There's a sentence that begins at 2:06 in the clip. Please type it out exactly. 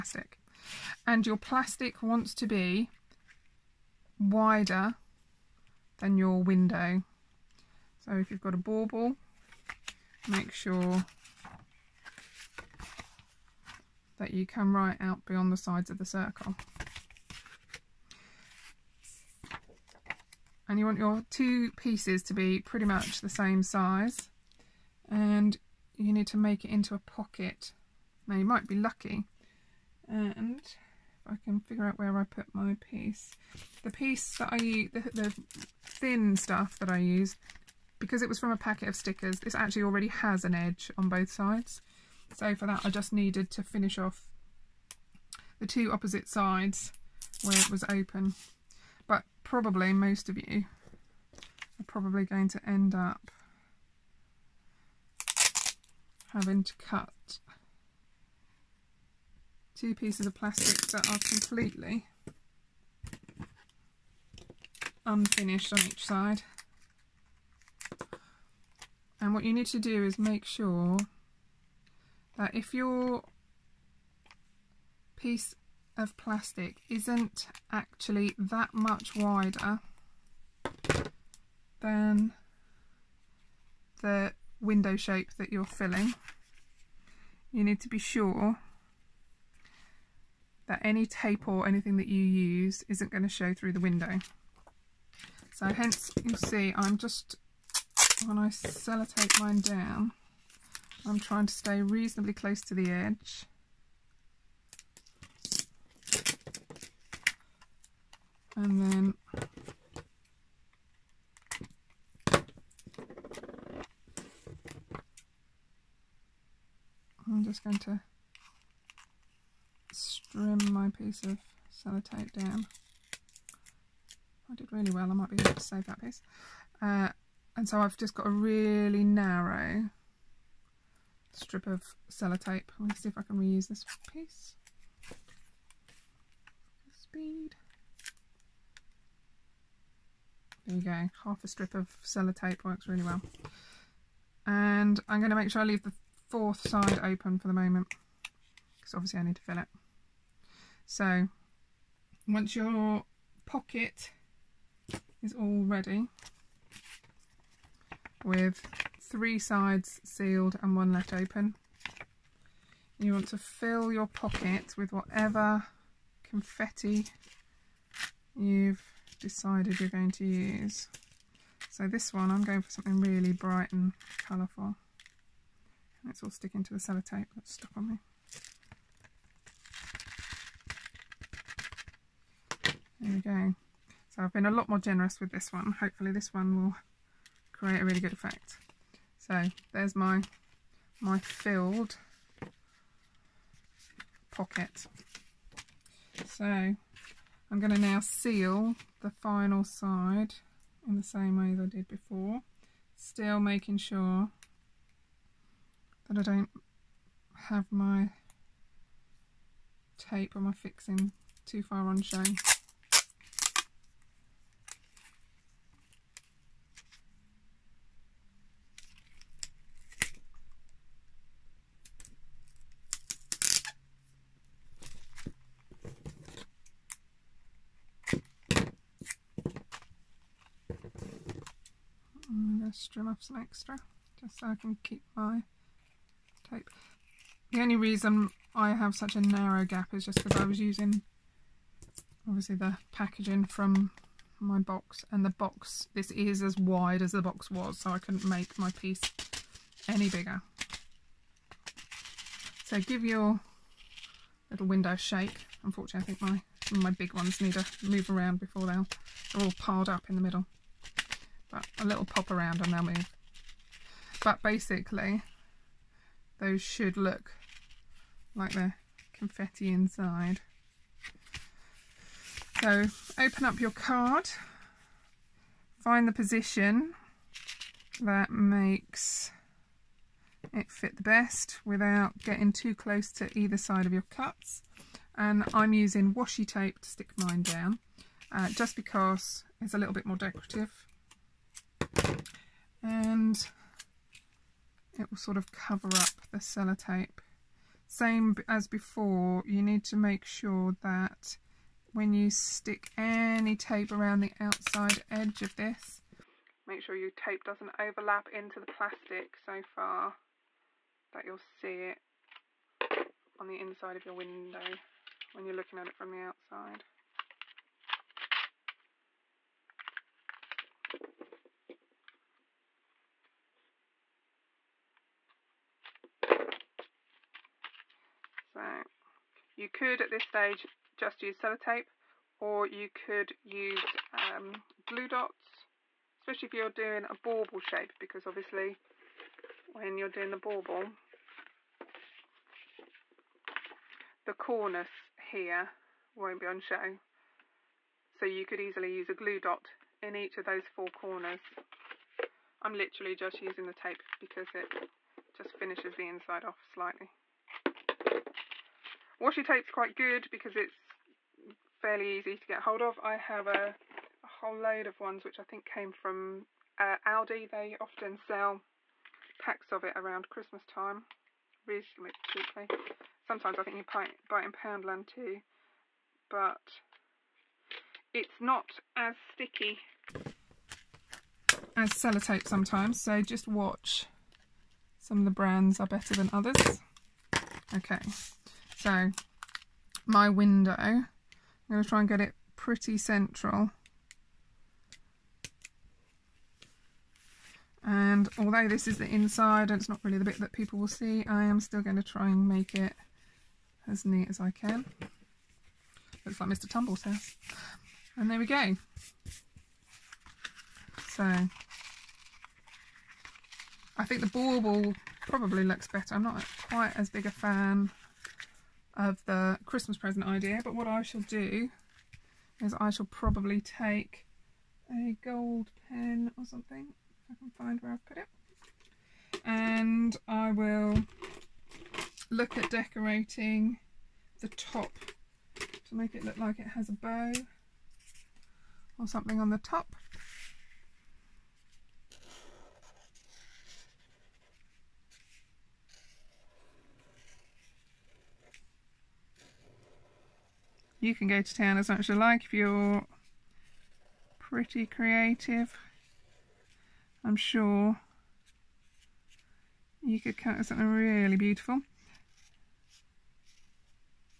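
Uh, and so I've just got a really narrow strip of sellotape.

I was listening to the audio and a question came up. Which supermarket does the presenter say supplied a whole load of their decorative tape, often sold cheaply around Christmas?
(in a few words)
Aldi.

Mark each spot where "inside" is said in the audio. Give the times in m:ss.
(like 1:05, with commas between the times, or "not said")
4:29, 5:13, 5:56, 6:39.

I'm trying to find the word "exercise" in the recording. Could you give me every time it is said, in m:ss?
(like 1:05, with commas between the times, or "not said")
not said.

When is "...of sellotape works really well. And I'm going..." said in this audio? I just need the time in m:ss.
2:21.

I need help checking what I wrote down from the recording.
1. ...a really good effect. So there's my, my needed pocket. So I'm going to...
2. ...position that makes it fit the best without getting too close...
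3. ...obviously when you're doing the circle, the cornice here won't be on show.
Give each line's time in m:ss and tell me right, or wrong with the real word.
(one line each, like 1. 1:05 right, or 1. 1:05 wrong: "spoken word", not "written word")
1. 3:07 wrong: "filled", not "needed"
2. 4:36 right
3. 5:38 wrong: "bauble", not "circle".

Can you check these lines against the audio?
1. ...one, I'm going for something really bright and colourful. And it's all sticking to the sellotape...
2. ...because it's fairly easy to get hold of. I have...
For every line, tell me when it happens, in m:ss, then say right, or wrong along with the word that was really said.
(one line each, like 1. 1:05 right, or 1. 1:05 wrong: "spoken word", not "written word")
1. 2:52 right
2. 6:00 right.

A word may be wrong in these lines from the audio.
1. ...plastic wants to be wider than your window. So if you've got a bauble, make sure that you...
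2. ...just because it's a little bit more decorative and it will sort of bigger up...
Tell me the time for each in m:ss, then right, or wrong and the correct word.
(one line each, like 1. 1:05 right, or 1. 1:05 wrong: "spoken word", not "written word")
1. 0:01 right
2. 4:48 wrong: "cover", not "bigger".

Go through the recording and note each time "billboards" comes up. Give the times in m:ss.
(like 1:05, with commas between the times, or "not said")
not said.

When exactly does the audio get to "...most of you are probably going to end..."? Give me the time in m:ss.
0:49.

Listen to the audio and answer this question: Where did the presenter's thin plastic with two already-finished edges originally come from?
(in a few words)
A packet of stickers.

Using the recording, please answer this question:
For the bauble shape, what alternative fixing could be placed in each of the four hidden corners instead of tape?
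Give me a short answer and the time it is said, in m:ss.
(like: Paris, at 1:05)
Glue dots, at 5:34.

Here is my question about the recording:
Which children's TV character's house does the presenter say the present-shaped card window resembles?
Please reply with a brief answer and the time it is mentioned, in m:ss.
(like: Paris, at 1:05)
Mr. Tumble, at 6:46.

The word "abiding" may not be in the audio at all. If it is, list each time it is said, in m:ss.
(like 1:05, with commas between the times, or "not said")
not said.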